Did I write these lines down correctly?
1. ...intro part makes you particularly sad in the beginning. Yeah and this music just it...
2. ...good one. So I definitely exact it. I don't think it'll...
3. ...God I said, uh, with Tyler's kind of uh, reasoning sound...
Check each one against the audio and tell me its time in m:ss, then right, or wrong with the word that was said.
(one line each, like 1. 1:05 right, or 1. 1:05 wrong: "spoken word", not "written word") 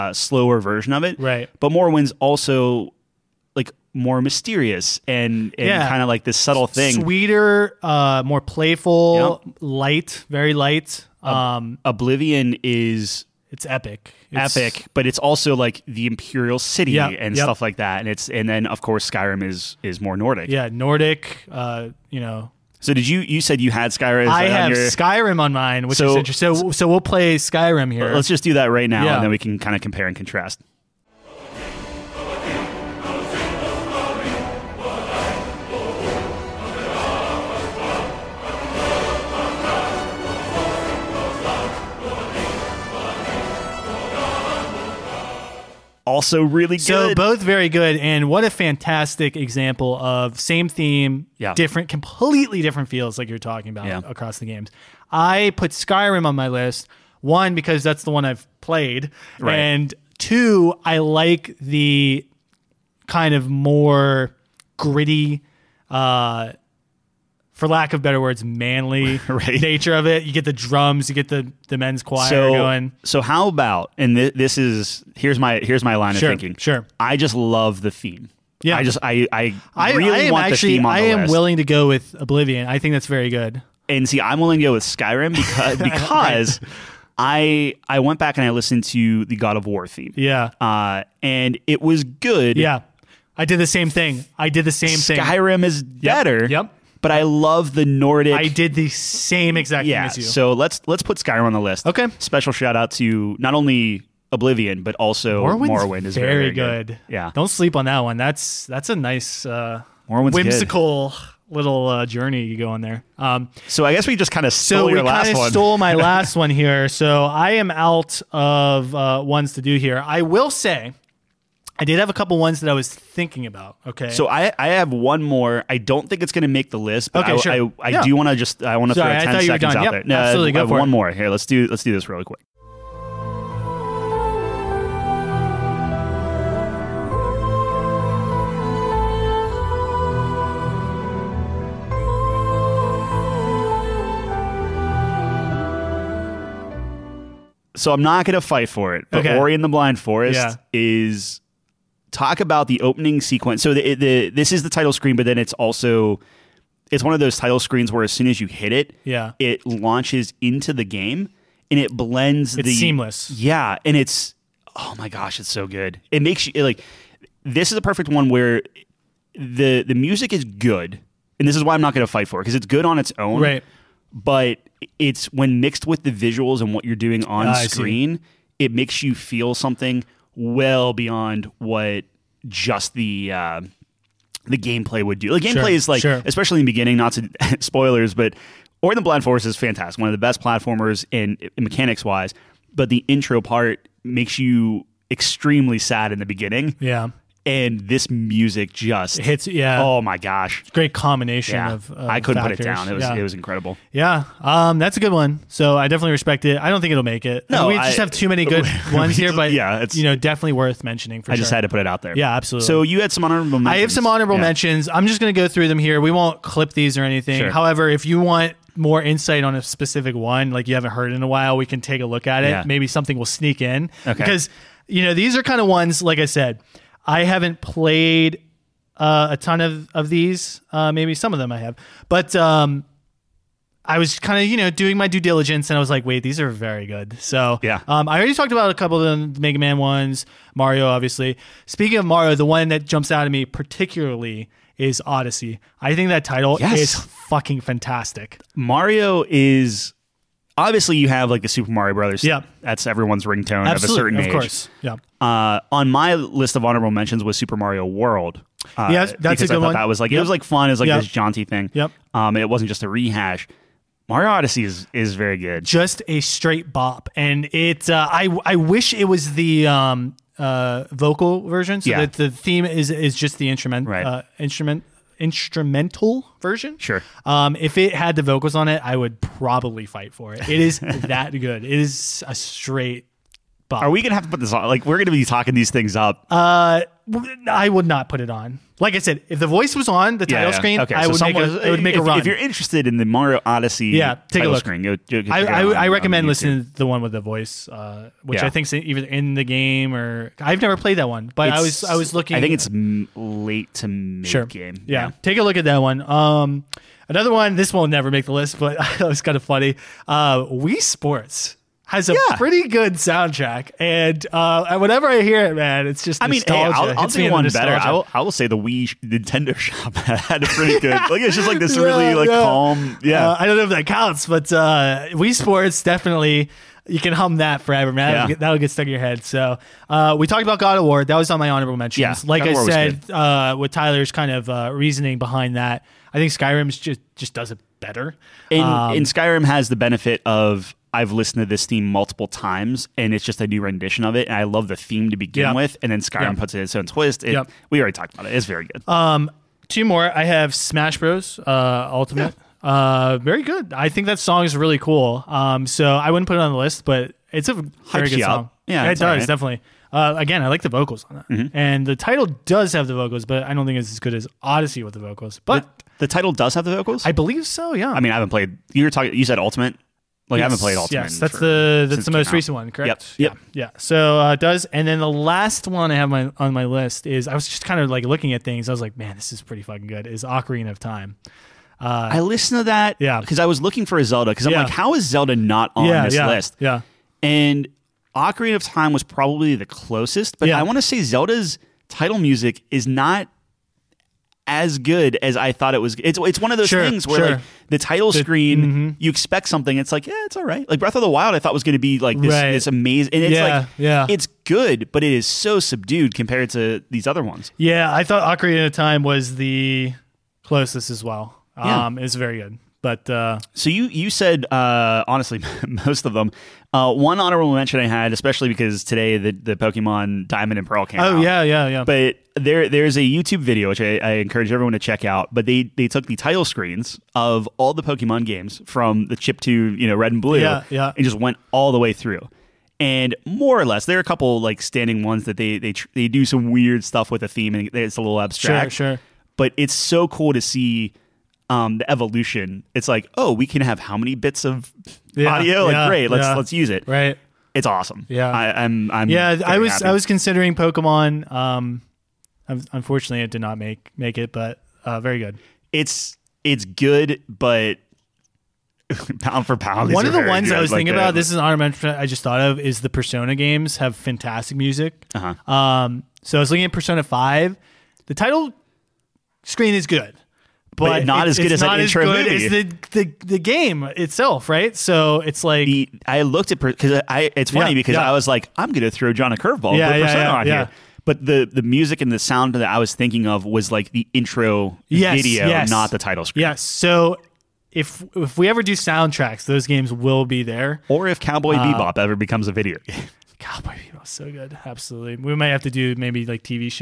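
1. 3:13 wrong: "extremely", not "particularly"
2. 3:24 wrong: "respect", not "exact"
3. 5:32 wrong: "behind", not "sound".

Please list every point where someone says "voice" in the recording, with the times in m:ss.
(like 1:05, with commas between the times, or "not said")
4:49, 4:57.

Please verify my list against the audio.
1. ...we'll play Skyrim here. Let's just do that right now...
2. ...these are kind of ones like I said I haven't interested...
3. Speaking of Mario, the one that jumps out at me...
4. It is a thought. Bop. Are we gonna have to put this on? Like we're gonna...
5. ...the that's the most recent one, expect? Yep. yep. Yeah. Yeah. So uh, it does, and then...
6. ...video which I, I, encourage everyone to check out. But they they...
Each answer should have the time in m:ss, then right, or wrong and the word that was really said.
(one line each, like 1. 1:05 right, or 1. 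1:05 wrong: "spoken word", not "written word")
1. 0:26 right
2. 3:45 wrong: "played", not "interested"
3. 4:01 right
4. 4:41 wrong: "straight", not "thought"
5. 6:11 wrong: "correct", not "expect"
6. 7:03 right.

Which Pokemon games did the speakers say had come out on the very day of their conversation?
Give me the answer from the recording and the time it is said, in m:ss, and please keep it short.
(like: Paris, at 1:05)
Diamond and Pearl, at 7:00.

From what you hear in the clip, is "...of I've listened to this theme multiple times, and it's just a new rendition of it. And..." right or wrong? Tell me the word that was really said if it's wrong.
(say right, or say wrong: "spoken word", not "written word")
right.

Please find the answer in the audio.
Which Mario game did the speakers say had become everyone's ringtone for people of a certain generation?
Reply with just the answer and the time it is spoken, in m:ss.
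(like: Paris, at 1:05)
Super Mario Brothers, at 4:11.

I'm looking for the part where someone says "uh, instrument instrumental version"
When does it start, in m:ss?
4:34.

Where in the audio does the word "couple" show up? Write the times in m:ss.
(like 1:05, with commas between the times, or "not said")
2:02, 3:58, 7:14.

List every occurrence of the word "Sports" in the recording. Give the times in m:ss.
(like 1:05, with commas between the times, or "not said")
5:10, 5:25.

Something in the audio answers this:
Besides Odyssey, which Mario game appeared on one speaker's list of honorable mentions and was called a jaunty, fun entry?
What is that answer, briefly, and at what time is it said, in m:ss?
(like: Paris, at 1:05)
Super Mario World, at 4:17.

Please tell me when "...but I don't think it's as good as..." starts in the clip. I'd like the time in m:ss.
6:03.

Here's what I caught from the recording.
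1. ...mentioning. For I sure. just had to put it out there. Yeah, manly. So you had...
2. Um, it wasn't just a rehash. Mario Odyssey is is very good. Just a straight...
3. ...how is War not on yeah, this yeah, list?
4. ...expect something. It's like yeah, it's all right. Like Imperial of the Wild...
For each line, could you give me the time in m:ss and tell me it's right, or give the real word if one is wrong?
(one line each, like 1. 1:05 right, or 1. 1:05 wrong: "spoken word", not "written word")
1. 3:30 wrong: "absolutely", not "manly"
2. 4:22 right
3. 6:24 wrong: "Zelda", not "War"
4. 6:39 wrong: "Breath", not "Imperial".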